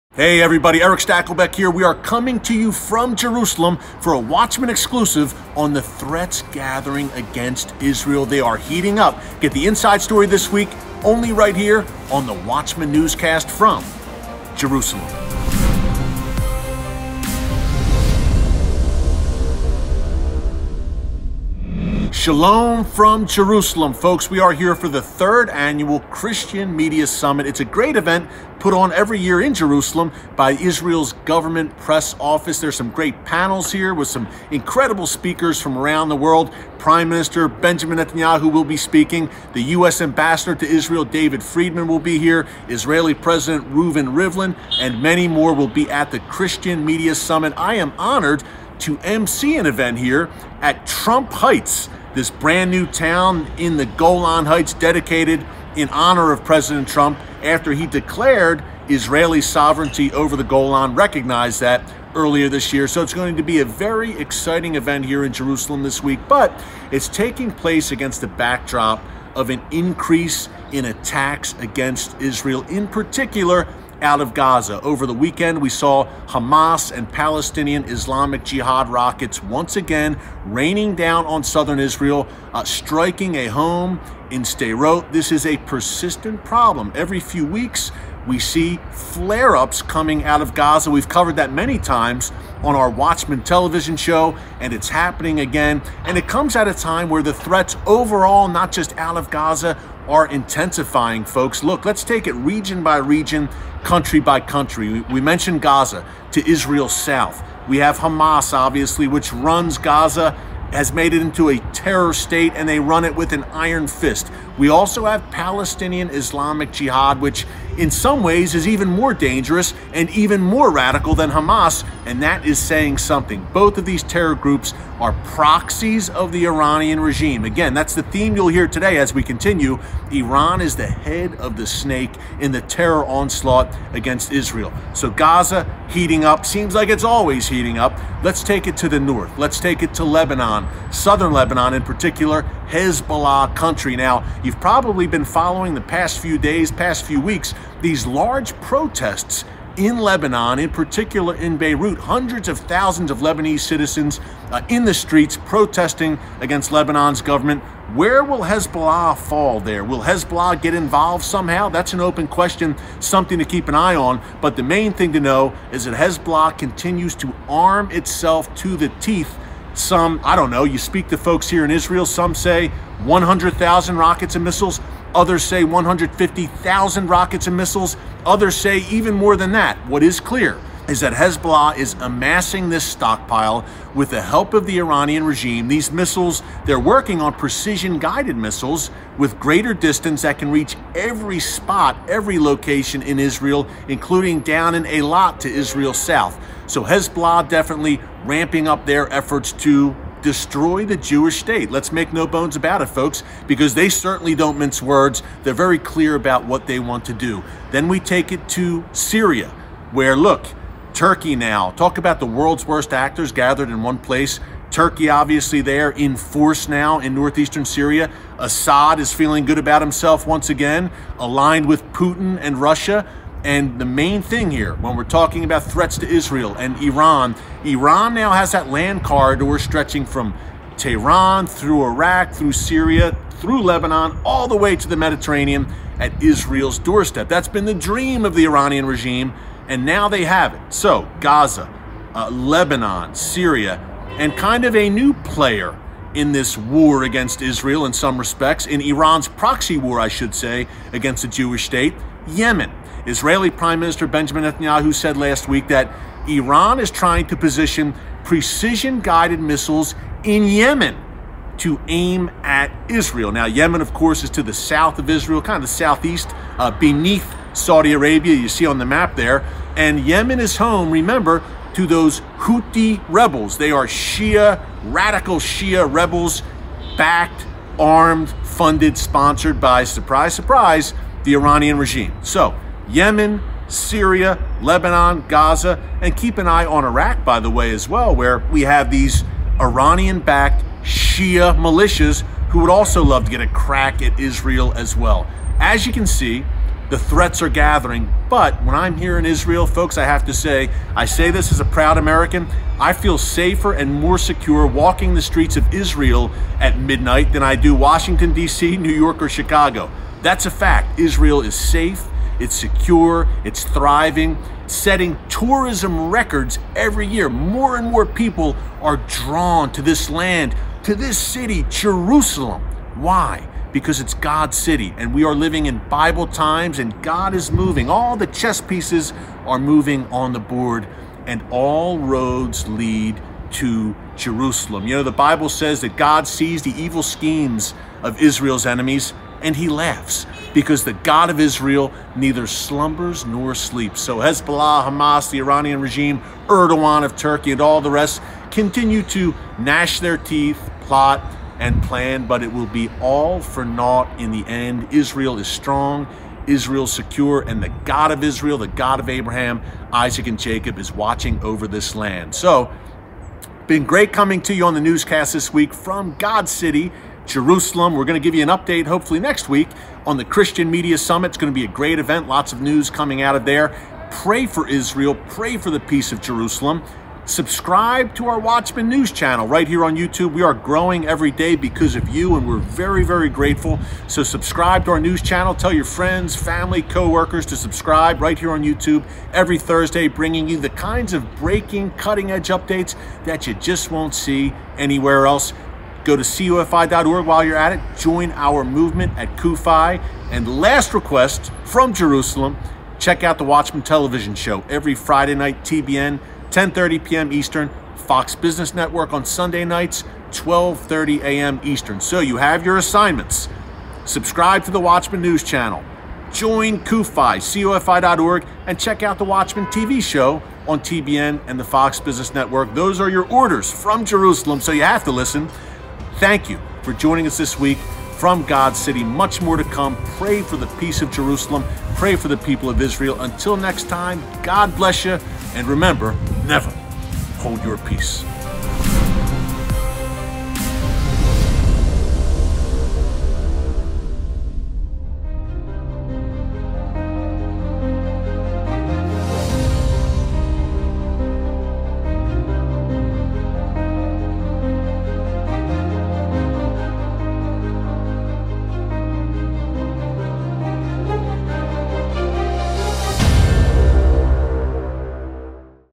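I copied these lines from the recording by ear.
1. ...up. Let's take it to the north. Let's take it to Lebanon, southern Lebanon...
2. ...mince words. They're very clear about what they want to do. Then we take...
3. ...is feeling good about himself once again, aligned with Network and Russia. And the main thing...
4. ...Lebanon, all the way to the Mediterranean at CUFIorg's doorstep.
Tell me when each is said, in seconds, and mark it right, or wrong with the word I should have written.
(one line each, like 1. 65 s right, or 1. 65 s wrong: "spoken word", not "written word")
1. 137 s right
2. 204 s right
3. 218 s wrong: "Putin", not "Network"
4. 233 s wrong: "Israel", not "CUFIorg".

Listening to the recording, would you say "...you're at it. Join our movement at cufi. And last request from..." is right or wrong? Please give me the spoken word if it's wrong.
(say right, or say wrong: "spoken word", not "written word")
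right.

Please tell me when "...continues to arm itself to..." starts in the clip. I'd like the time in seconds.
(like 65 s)
166 s.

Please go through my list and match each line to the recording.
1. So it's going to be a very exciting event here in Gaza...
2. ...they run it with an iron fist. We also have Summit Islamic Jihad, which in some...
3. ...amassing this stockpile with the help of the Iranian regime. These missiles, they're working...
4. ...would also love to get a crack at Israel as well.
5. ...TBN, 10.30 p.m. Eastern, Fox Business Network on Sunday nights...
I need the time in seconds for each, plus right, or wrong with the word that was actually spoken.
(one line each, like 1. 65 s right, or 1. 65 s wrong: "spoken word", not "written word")
1. 62 s wrong: "Jerusalem", not "Gaza"
2. 112 s wrong: "Palestinian", not "Summit"
3. 182 s right
4. 292 s right
5. 405 s right.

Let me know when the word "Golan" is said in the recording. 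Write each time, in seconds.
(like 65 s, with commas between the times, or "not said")
53 s, 60 s.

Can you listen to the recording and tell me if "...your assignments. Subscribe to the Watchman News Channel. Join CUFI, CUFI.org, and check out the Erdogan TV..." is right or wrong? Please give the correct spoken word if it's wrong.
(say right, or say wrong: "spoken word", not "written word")
wrong: "Watchman", not "Erdogan".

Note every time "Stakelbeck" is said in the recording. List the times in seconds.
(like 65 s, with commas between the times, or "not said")
0 s.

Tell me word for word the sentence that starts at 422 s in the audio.
Those are your orders from Jerusalem, so you have to listen.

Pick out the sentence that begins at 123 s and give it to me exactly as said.
Both of these terror groups are proxies of the Iranian regime.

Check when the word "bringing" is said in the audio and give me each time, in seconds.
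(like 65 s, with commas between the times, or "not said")
390 s.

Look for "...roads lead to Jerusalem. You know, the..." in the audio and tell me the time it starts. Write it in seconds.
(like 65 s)
331 s.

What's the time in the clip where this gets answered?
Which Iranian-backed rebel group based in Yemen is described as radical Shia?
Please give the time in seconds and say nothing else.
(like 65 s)
272 s.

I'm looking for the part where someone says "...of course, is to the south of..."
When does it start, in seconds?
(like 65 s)
263 s.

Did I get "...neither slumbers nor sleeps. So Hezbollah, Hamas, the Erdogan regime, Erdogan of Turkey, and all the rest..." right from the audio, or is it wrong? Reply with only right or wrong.
wrong.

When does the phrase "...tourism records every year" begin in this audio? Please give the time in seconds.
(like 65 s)
315 s.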